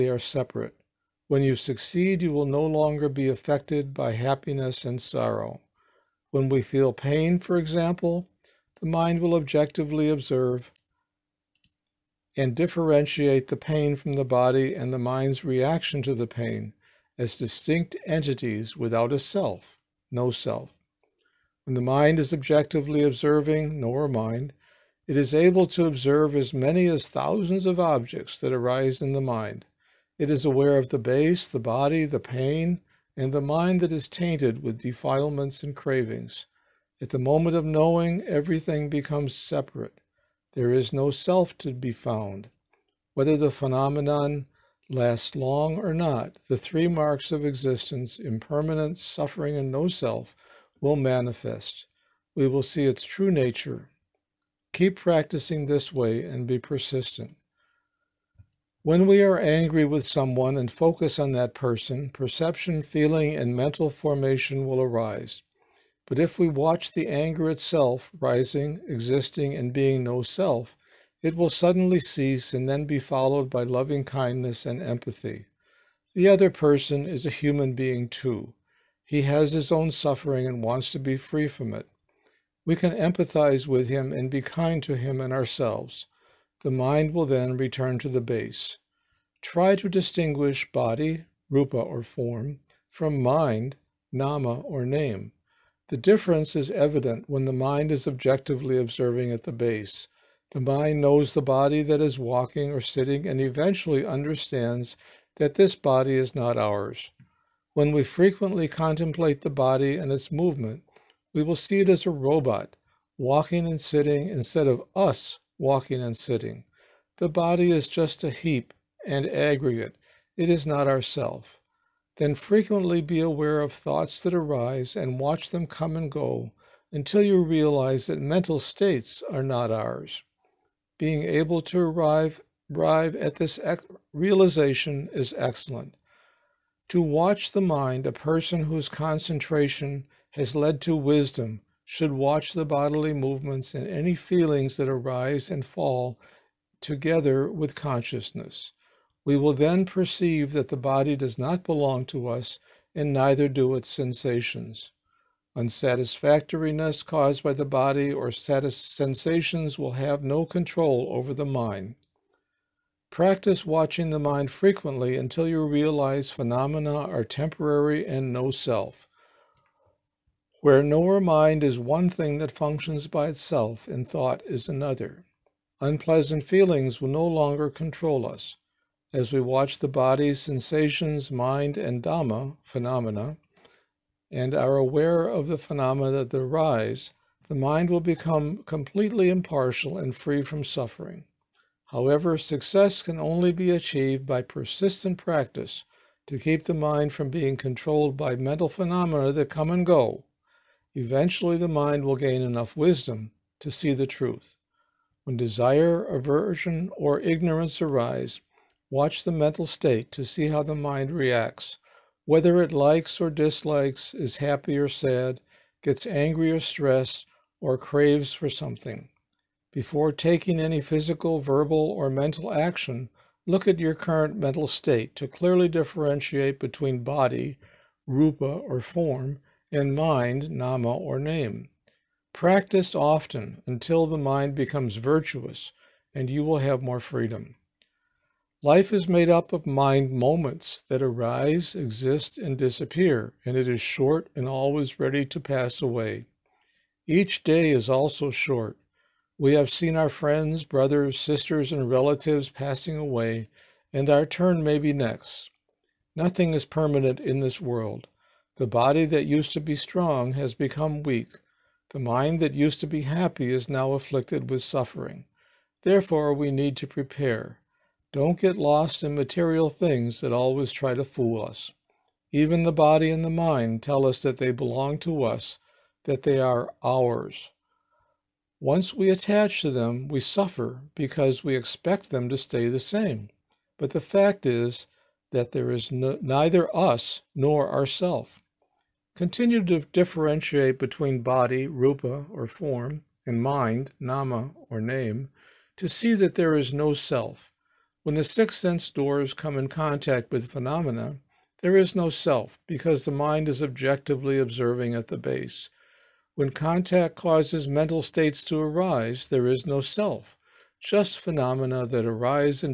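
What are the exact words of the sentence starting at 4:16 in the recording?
Nothing is permanent in this world.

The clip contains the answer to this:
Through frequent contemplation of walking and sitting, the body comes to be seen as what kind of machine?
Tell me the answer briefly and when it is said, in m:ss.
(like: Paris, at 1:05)
a robot, at 1:52.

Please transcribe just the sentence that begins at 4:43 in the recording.
But the fact is that there is no, neither us nor ourself.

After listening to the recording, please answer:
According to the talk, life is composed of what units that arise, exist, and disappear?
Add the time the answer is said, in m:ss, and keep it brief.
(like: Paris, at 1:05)
mind moments, at 3:59.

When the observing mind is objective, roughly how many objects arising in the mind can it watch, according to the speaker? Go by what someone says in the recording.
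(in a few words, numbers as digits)
thousands.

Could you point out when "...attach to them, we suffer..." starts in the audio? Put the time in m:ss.
4:39.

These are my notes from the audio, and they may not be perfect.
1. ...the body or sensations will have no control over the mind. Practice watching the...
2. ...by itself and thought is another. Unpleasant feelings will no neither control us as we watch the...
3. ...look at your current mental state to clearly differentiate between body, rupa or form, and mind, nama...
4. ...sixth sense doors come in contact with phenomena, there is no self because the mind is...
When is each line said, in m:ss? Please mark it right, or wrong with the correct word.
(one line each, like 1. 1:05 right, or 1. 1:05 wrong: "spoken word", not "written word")
1. 2:37 right
2. 2:53 wrong: "longer", not "neither"
3. 3:43 right
4. 4:58 right.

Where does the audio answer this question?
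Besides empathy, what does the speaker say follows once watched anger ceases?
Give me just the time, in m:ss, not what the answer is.
1:13.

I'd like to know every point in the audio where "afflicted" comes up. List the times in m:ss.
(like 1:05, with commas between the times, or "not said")
4:23.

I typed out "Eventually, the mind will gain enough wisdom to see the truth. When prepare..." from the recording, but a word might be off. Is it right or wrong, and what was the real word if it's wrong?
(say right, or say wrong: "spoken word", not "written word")
wrong: "desire", not "prepare".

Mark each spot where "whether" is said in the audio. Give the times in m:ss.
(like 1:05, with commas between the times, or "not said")
0:43, 3:32.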